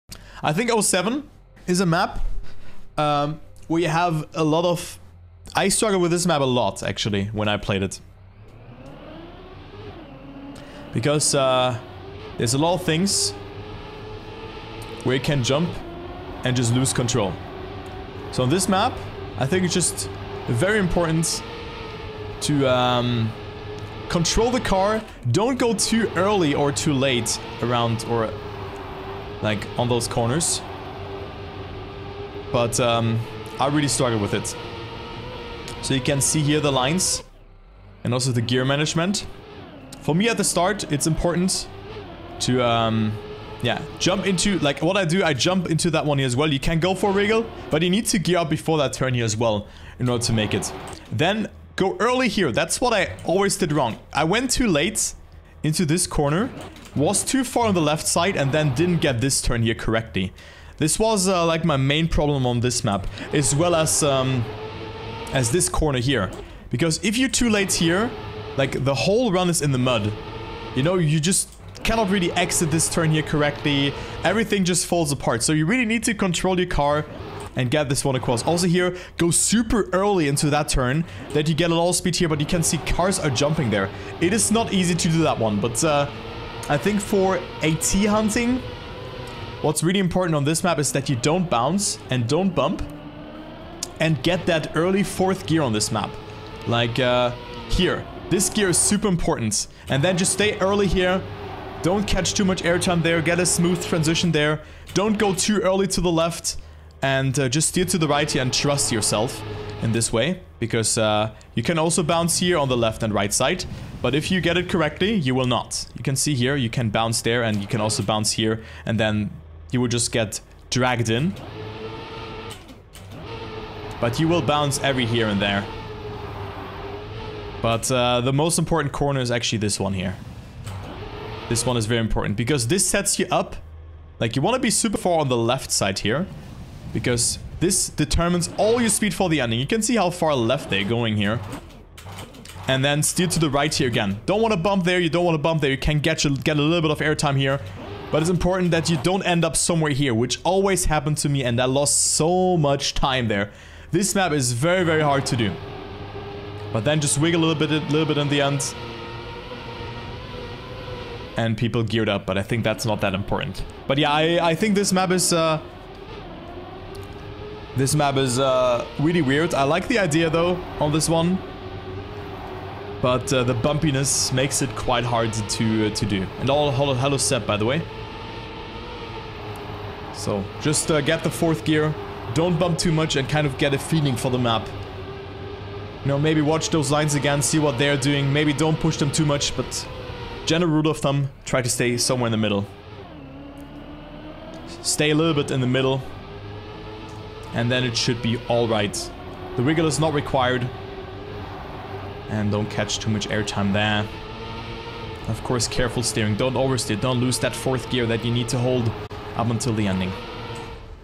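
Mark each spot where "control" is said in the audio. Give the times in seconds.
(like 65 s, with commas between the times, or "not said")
16 s, 24 s, 76 s.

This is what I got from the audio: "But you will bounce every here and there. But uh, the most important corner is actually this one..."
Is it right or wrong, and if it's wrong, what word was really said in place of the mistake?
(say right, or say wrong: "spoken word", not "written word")
right.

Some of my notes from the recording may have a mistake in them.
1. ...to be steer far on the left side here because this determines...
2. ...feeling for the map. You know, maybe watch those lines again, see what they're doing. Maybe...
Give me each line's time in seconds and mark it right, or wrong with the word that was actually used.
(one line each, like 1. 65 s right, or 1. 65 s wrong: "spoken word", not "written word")
1. 134 s wrong: "super", not "steer"
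2. 183 s right.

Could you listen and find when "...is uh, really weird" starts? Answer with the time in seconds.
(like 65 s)
168 s.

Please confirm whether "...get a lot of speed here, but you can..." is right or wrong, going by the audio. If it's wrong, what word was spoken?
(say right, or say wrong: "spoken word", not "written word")
right.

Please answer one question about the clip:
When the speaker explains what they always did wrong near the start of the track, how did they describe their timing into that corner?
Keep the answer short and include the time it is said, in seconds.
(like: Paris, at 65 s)
Went too late, at 54 s.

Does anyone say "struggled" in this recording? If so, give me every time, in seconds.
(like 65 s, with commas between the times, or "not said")
5 s, 33 s.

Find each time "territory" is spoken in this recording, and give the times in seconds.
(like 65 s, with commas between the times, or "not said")
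not said.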